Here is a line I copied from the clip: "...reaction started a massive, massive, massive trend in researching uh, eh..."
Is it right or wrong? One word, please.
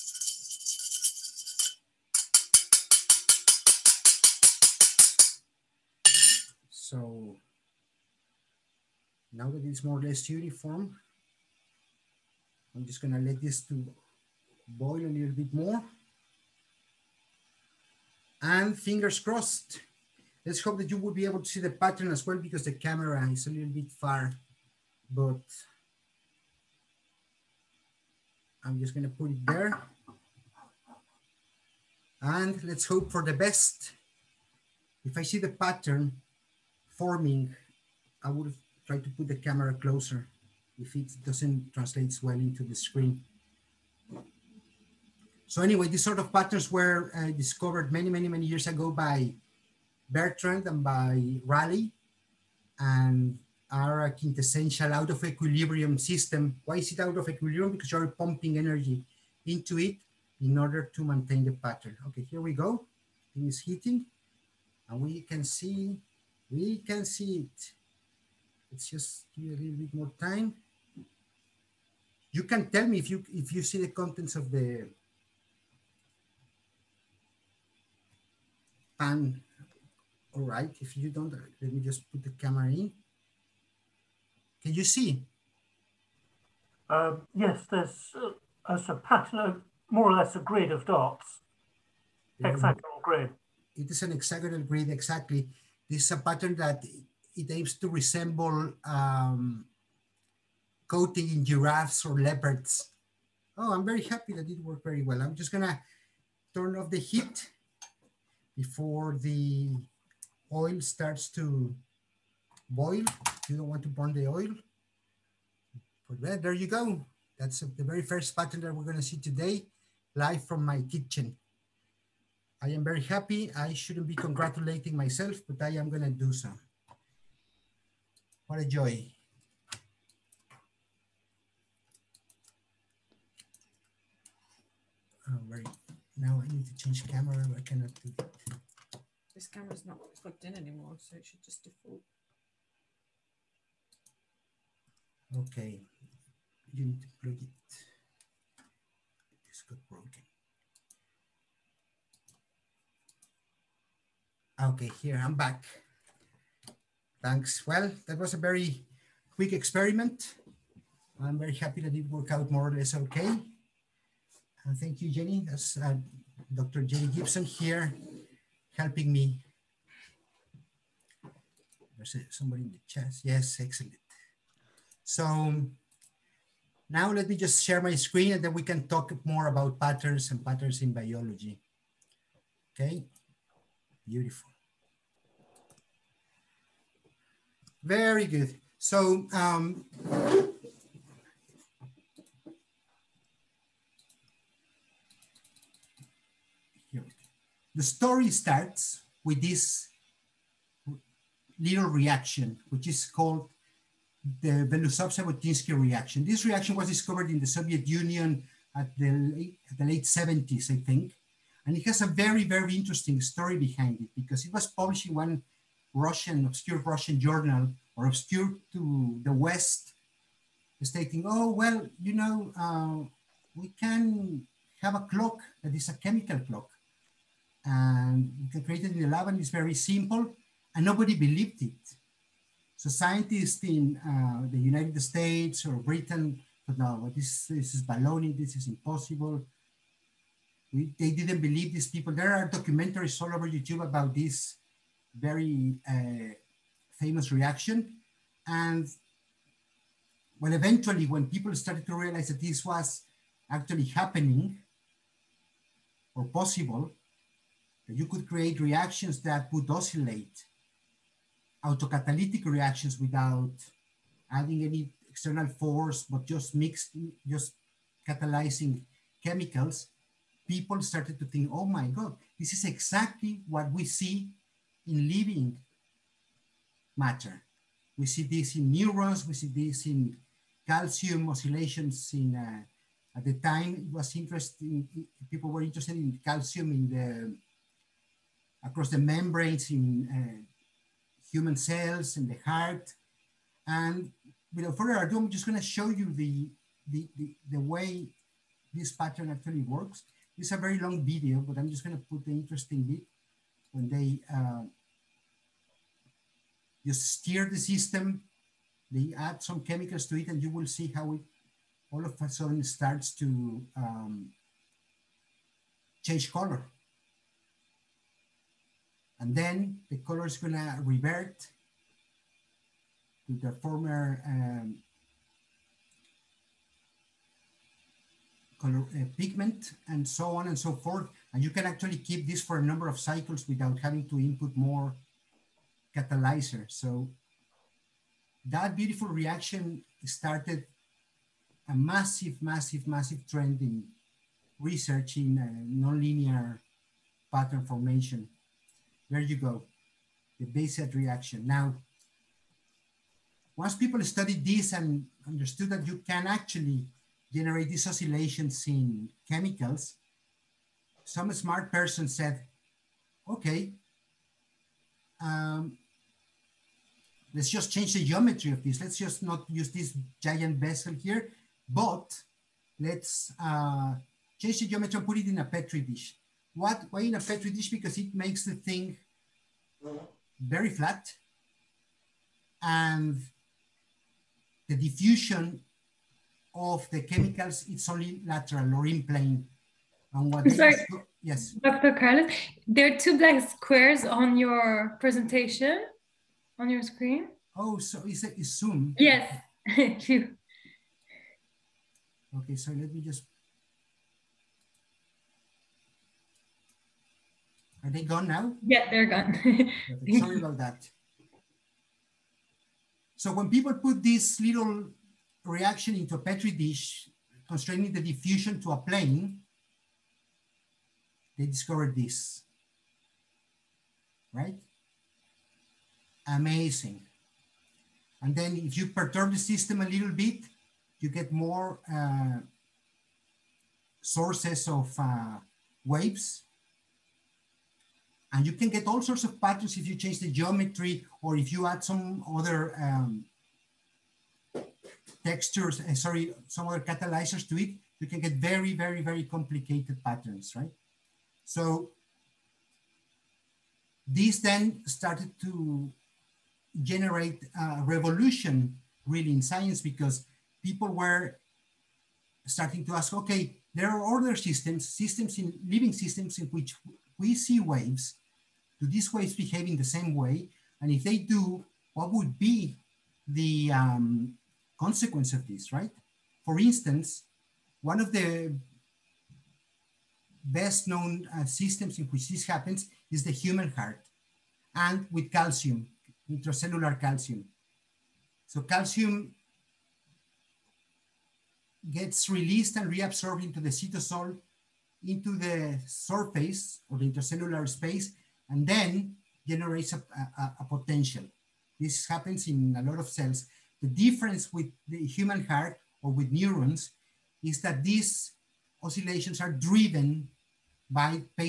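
right.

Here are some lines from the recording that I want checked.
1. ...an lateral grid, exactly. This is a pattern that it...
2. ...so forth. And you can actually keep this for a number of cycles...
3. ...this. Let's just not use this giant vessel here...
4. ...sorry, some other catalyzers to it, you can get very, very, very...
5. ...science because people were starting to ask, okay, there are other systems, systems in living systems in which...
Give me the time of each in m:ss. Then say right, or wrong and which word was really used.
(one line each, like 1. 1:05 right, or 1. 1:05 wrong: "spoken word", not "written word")
1. 1:34 wrong: "hexagonal", not "lateral"
2. 5:30 right
3. 6:08 right
4. 7:25 right
5. 7:39 right.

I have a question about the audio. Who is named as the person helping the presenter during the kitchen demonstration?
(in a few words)
Dr. Jenny Gibson.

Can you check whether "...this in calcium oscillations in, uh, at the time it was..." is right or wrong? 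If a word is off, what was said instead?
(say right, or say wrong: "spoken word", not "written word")
right.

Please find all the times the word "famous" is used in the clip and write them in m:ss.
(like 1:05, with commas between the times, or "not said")
4:06.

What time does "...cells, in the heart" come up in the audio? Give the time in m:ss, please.
4:51.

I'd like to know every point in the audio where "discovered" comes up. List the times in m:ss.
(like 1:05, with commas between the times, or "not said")
0:47, 3:26, 7:01.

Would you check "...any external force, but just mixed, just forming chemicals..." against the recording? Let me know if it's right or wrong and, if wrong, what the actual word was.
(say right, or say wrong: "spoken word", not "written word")
wrong: "catalyzing", not "forming".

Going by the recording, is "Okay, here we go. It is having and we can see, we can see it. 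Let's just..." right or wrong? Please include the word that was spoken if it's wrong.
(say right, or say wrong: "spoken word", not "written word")
wrong: "heating", not "having".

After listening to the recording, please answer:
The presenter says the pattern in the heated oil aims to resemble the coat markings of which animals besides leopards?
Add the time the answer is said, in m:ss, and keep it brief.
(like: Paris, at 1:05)
Giraffes, at 1:41.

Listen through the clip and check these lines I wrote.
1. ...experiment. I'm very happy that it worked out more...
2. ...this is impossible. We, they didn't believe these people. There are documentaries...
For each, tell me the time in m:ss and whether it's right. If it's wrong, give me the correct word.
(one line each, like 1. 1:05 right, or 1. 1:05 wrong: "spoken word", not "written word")
1. 2:39 right
2. 3:58 right.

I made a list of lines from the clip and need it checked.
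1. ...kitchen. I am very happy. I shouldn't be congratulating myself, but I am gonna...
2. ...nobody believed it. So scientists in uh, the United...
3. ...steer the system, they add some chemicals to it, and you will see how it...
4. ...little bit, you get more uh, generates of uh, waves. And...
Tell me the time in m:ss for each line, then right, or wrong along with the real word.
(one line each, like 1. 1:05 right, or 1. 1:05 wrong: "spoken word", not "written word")
1. 2:00 right
2. 3:50 right
3. 5:07 right
4. 7:09 wrong: "sources", not "generates".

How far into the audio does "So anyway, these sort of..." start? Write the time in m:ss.
0:45.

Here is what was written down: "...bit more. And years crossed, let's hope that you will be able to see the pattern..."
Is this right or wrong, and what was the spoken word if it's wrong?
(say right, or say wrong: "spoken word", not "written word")
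wrong: "fingers", not "years".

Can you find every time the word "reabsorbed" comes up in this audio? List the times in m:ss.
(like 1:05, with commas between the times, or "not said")
8:12.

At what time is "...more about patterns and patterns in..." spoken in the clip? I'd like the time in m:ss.
2:59.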